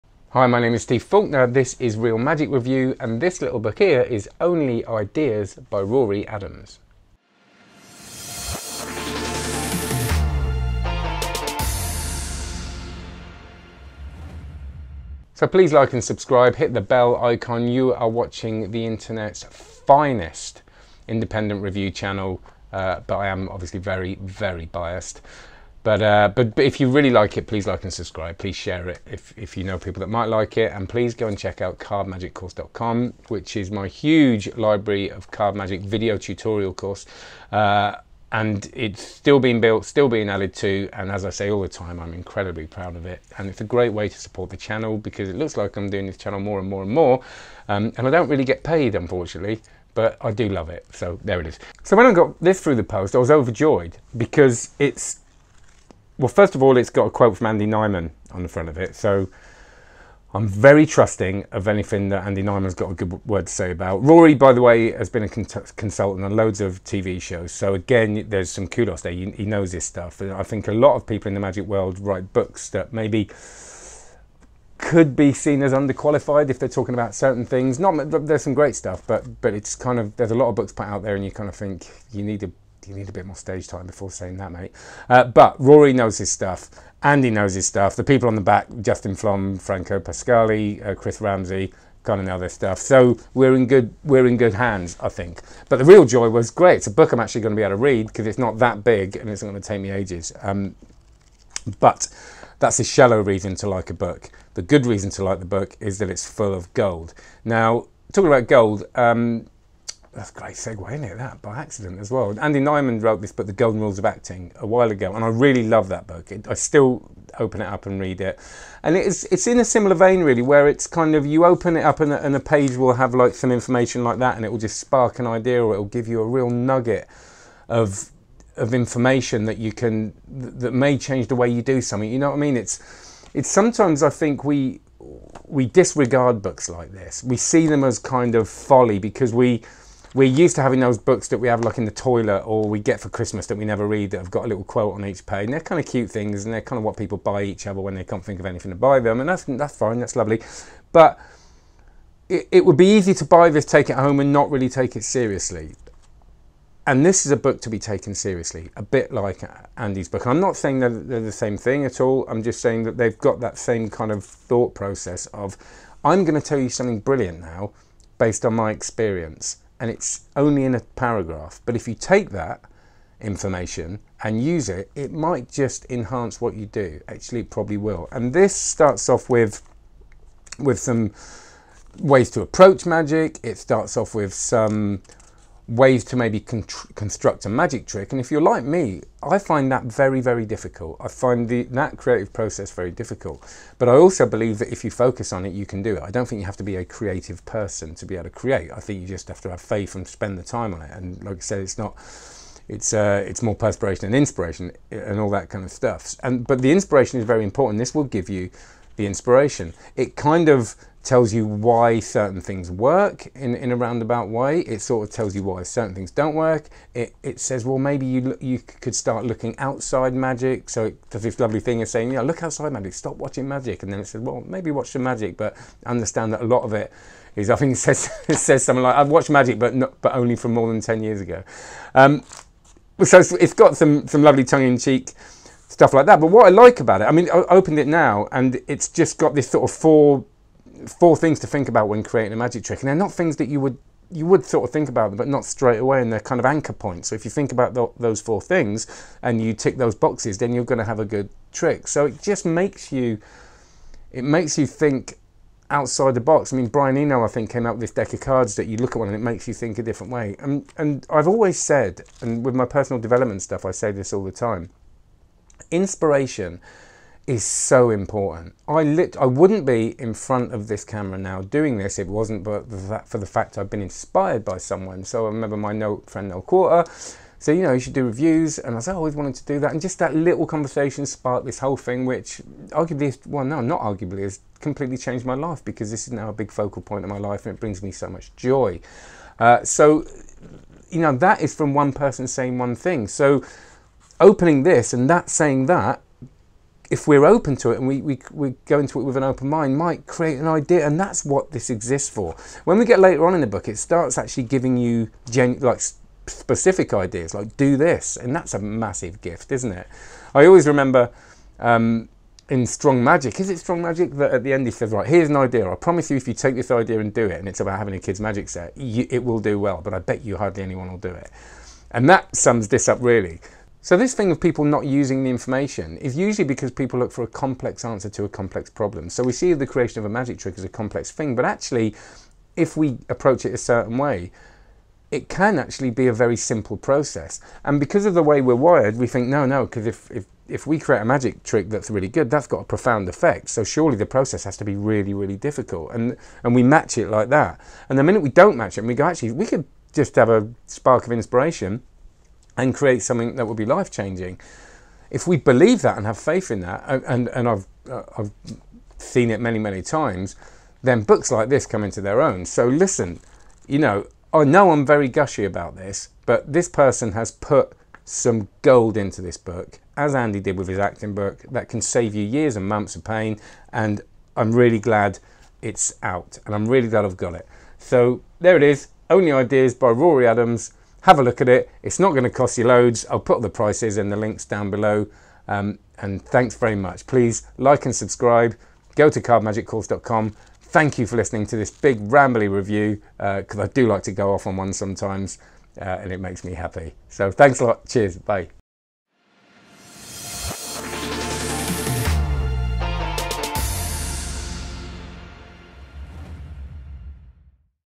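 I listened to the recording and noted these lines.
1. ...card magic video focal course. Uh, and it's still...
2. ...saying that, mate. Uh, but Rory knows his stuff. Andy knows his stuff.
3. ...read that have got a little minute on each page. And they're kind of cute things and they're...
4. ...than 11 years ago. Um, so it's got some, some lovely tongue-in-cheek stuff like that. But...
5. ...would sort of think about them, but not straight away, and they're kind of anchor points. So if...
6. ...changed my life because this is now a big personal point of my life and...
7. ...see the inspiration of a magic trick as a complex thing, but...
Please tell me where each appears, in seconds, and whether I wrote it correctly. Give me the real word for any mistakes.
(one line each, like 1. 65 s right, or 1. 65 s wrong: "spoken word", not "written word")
1. 35 s wrong: "tutorial", not "focal"
2. 84 s right
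3. 143 s wrong: "quote", not "minute"
4. 230 s wrong: "10", not "11"
5. 244 s right
6. 284 s wrong: "focal", not "personal"
7. 329 s wrong: "creation", not "inspiration".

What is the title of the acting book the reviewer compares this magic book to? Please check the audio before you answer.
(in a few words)
The Golden Rules of Acting.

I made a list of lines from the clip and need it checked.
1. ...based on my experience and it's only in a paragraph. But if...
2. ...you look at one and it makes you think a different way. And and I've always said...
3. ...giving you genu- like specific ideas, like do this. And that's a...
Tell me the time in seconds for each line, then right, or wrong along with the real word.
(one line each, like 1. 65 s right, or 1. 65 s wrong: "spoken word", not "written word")
1. 168 s right
2. 258 s right
3. 304 s right.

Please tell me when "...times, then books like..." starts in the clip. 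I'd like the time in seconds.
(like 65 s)
359 s.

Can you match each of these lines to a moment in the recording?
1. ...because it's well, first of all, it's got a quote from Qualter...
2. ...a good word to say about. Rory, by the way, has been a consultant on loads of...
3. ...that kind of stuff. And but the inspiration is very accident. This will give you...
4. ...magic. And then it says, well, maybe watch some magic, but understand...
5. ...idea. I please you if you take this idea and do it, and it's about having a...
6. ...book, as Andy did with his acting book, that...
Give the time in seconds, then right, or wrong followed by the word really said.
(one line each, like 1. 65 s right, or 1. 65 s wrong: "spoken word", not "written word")
1. 54 s wrong: "Andy", not "Qualter"
2. 62 s right
3. 205 s wrong: "important", not "accident"
4. 223 s right
5. 315 s wrong: "promise", not "please"
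6. 369 s right.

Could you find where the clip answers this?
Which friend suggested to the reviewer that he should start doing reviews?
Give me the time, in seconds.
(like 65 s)
276 s.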